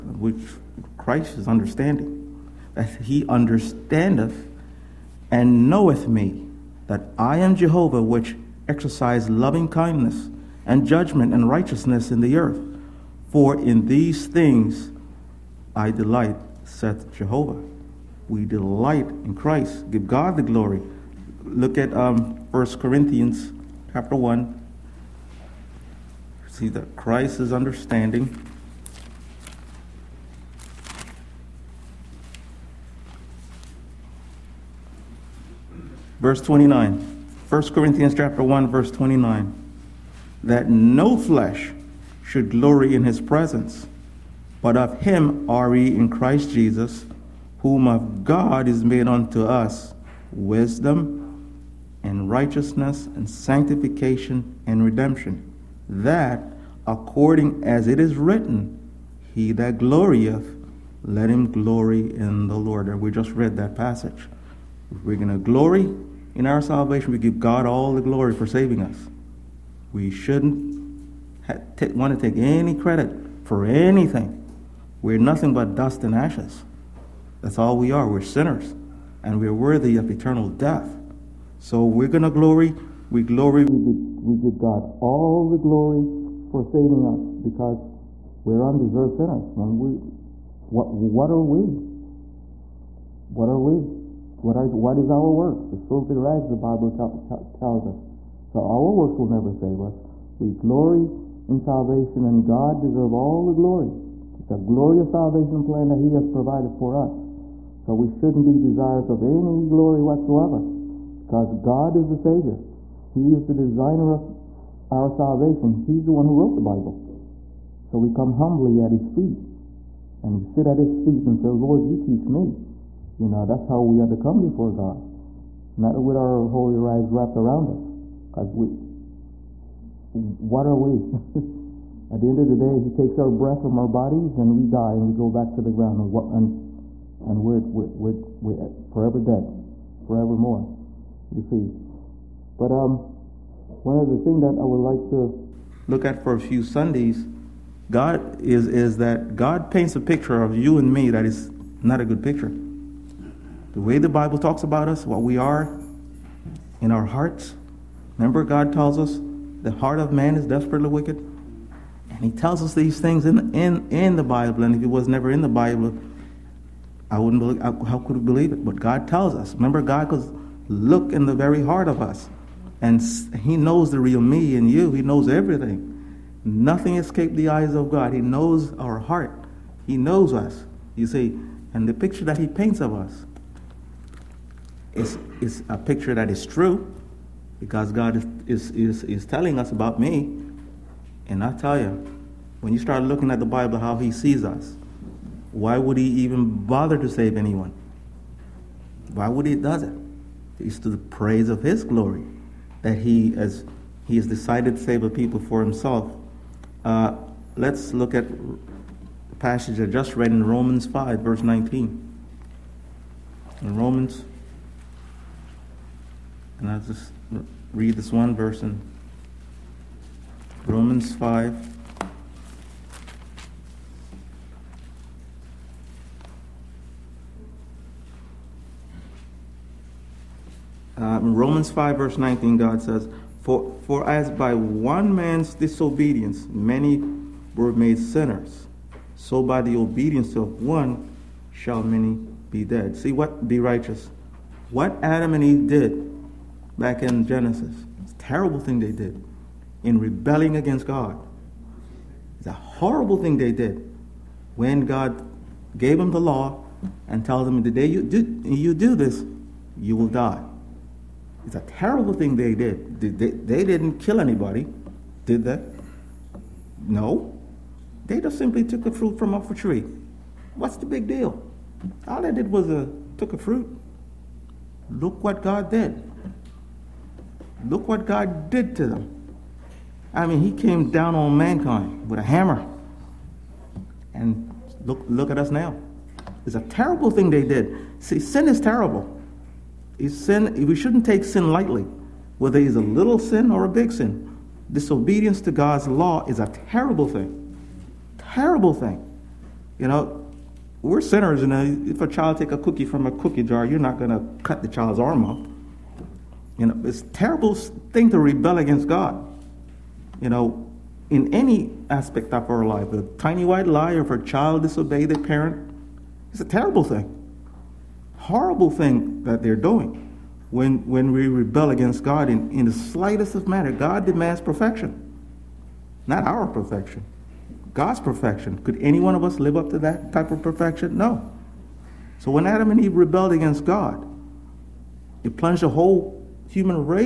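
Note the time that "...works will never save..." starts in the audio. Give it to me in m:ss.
1:38.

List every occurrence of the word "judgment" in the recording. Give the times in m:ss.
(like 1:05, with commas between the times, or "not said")
0:10.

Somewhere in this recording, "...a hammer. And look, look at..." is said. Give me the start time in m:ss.
4:42.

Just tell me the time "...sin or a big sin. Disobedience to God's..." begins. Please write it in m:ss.
4:53.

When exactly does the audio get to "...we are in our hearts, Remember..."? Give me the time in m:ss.
2:35.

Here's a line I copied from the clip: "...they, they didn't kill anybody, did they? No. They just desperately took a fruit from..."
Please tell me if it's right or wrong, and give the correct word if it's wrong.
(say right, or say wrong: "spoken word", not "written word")
wrong: "simply", not "desperately".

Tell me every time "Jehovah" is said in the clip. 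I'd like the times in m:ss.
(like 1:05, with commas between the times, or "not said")
0:07, 0:17.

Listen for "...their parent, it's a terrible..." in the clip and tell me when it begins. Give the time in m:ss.
5:15.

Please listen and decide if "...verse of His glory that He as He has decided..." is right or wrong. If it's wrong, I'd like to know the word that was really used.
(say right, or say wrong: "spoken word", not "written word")
wrong: "praise", not "verse".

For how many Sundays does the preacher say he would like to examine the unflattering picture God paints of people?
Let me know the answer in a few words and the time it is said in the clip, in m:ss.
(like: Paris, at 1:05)
A few, at 2:26.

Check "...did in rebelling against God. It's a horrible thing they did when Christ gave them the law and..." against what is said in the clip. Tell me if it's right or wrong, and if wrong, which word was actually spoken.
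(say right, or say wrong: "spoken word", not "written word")
wrong: "God", not "Christ".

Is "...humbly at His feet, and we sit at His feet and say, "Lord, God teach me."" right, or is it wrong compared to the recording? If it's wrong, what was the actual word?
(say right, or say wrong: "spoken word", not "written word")
wrong: "You", not "God".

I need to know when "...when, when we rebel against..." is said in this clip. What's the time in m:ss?
5:20.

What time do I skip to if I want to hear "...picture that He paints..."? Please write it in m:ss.
3:01.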